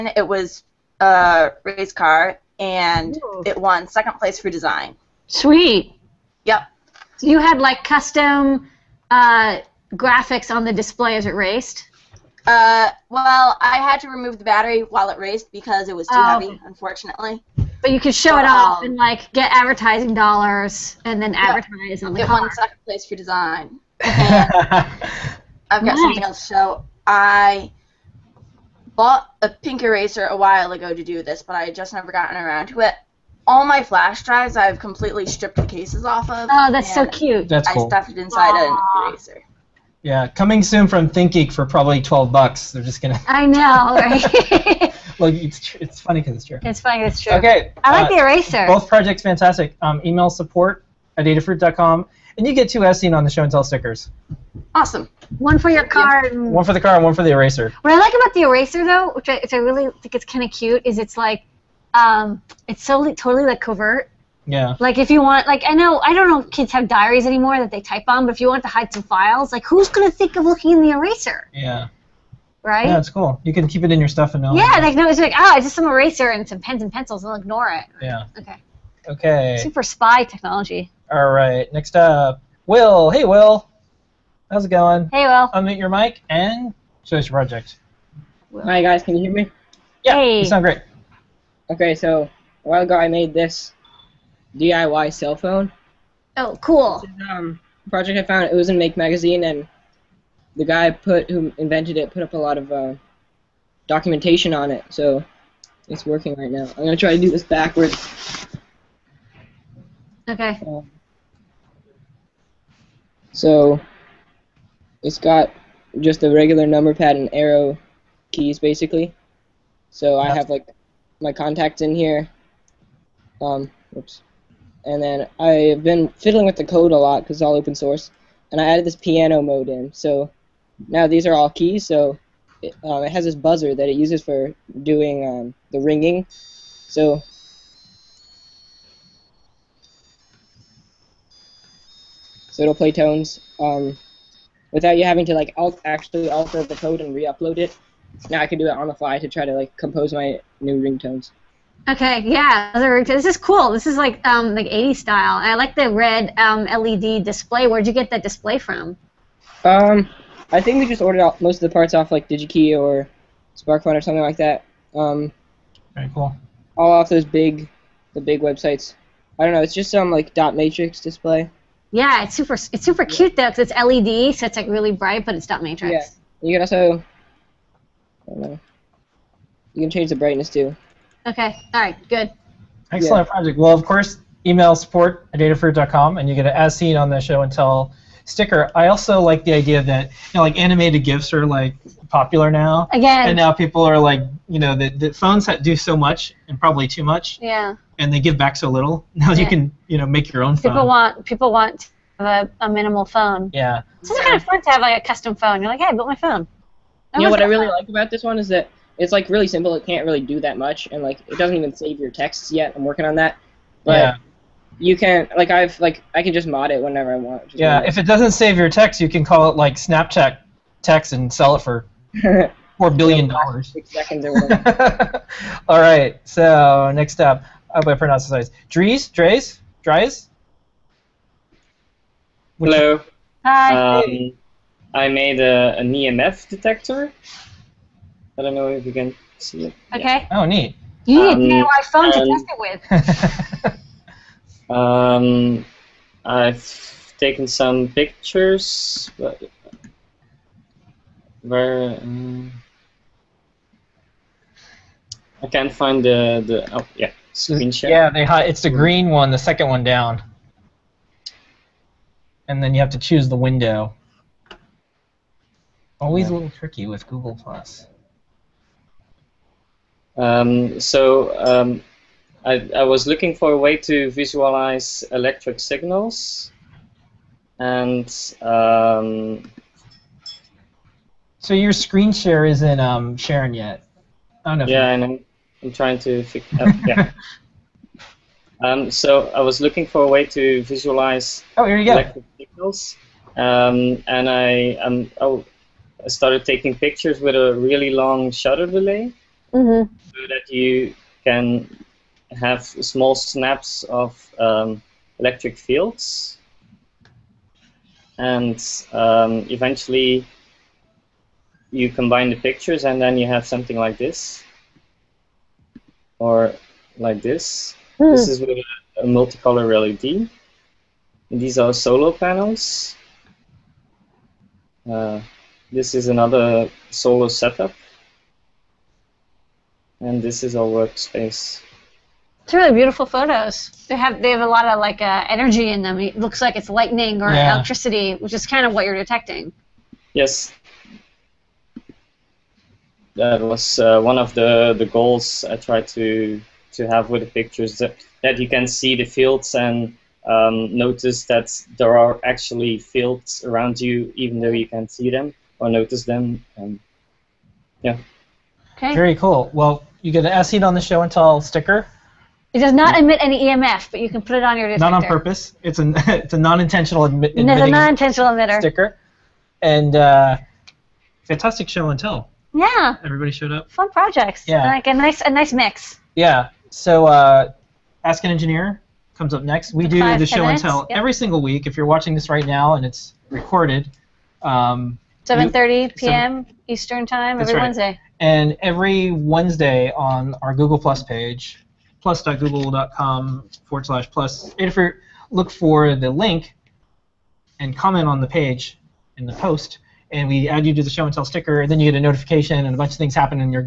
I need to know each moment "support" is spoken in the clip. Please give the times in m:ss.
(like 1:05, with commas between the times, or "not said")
0:50, 3:04.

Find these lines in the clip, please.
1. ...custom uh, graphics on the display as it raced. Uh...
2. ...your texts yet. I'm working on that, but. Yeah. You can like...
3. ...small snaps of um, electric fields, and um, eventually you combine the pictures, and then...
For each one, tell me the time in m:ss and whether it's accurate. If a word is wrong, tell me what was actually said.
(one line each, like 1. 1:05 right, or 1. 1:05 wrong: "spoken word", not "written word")
1. 0:07 right
2. 3:31 right
3. 5:02 right.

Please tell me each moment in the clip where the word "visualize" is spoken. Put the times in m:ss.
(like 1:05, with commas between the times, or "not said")
4:34, 4:50.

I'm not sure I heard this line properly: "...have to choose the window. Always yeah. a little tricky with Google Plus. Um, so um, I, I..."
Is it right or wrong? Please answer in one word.
right.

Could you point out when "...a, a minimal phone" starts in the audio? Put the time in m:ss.
3:22.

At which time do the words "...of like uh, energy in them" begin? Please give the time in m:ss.
5:34.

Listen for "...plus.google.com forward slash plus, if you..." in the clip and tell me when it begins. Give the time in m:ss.
6:32.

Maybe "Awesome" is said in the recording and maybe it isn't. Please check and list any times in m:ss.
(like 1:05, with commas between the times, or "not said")
0:54.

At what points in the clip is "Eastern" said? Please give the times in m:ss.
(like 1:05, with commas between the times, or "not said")
6:26.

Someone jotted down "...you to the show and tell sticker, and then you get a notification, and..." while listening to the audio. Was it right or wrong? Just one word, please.
right.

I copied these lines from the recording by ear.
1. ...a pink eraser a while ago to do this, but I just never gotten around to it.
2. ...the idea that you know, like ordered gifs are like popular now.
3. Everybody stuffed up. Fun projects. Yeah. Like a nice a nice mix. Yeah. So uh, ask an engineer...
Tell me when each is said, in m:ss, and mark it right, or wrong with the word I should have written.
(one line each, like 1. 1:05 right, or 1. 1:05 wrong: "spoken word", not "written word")
1. 0:29 right
2. 3:09 wrong: "animated", not "ordered"
3. 6:13 wrong: "showed", not "stuffed".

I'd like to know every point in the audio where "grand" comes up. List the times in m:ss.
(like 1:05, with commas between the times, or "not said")
not said.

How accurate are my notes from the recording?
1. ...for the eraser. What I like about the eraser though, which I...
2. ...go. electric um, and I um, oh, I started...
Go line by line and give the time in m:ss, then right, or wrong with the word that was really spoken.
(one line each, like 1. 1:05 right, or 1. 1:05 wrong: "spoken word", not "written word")
1. 0:57 right
2. 4:51 right.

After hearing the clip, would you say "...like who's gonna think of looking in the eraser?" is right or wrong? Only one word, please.
right.